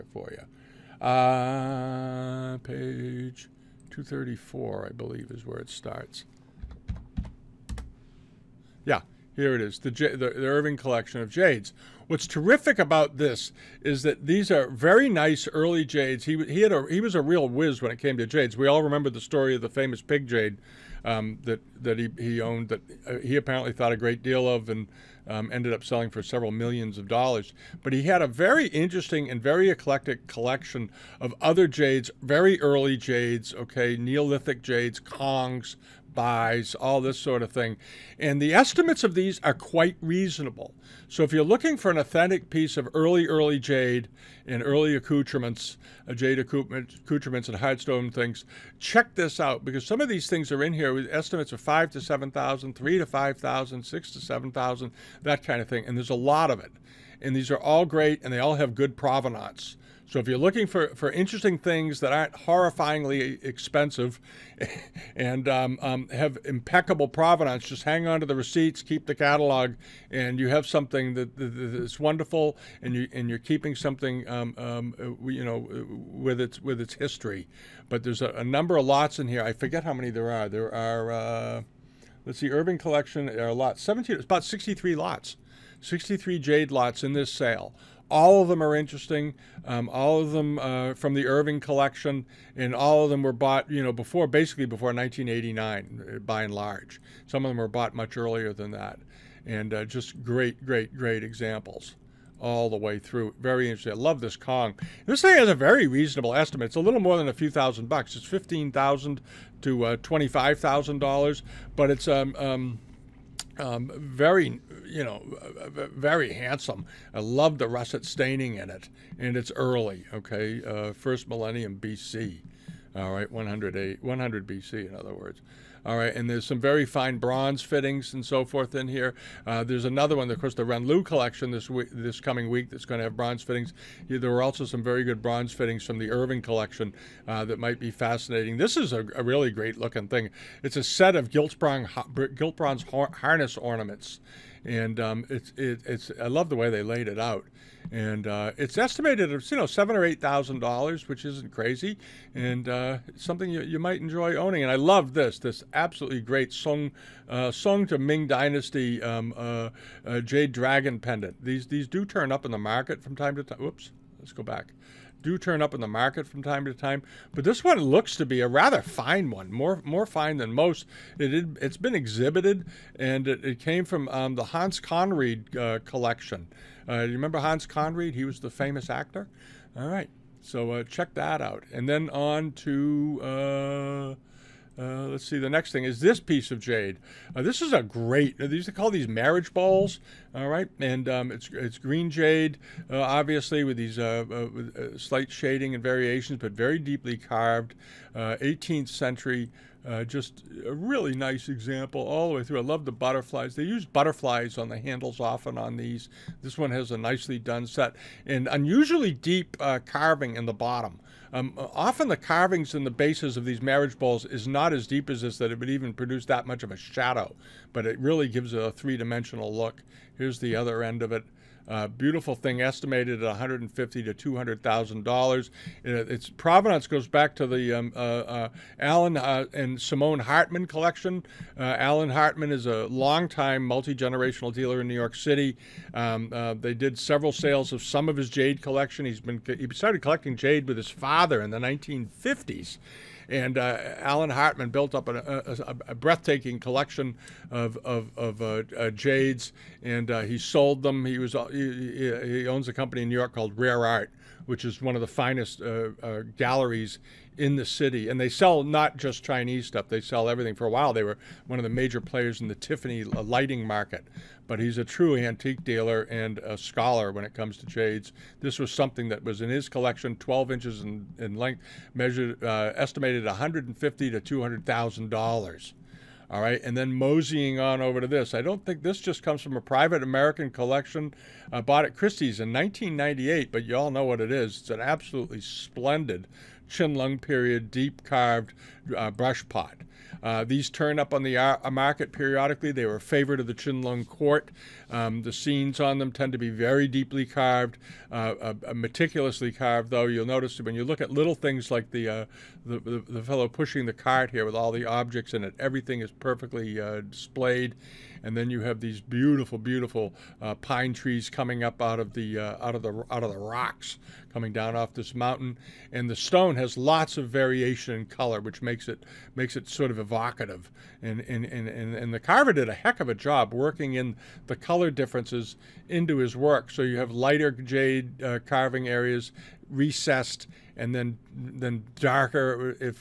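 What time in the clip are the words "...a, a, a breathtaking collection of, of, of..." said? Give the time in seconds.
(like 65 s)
245 s.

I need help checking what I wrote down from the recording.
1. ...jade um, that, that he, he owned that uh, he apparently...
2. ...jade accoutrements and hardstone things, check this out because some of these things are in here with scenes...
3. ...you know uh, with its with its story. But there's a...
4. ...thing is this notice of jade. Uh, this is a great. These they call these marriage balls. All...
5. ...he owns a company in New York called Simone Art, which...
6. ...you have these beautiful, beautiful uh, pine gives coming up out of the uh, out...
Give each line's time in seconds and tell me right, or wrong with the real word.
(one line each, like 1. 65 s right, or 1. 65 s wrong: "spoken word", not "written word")
1. 20 s right
2. 46 s wrong: "estimates", not "scenes"
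3. 75 s wrong: "history", not "story"
4. 185 s wrong: "piece", not "notice"
5. 252 s wrong: "Rare", not "Simone"
6. 308 s wrong: "trees", not "gives".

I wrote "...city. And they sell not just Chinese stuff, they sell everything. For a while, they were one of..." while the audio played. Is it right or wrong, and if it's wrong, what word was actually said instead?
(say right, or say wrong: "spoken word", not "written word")
right.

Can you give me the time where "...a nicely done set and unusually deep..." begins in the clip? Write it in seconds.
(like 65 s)
206 s.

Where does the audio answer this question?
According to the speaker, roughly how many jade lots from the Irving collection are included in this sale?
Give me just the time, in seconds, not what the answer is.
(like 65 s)
84 s.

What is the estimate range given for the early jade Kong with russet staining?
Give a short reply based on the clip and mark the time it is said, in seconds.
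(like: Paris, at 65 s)
$15,000 to $25,000, at 108 s.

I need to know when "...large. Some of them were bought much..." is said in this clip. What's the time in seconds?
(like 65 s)
96 s.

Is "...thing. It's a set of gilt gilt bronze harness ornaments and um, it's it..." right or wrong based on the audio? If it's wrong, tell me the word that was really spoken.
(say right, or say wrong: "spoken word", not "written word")
right.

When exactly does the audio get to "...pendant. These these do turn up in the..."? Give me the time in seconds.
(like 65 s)
160 s.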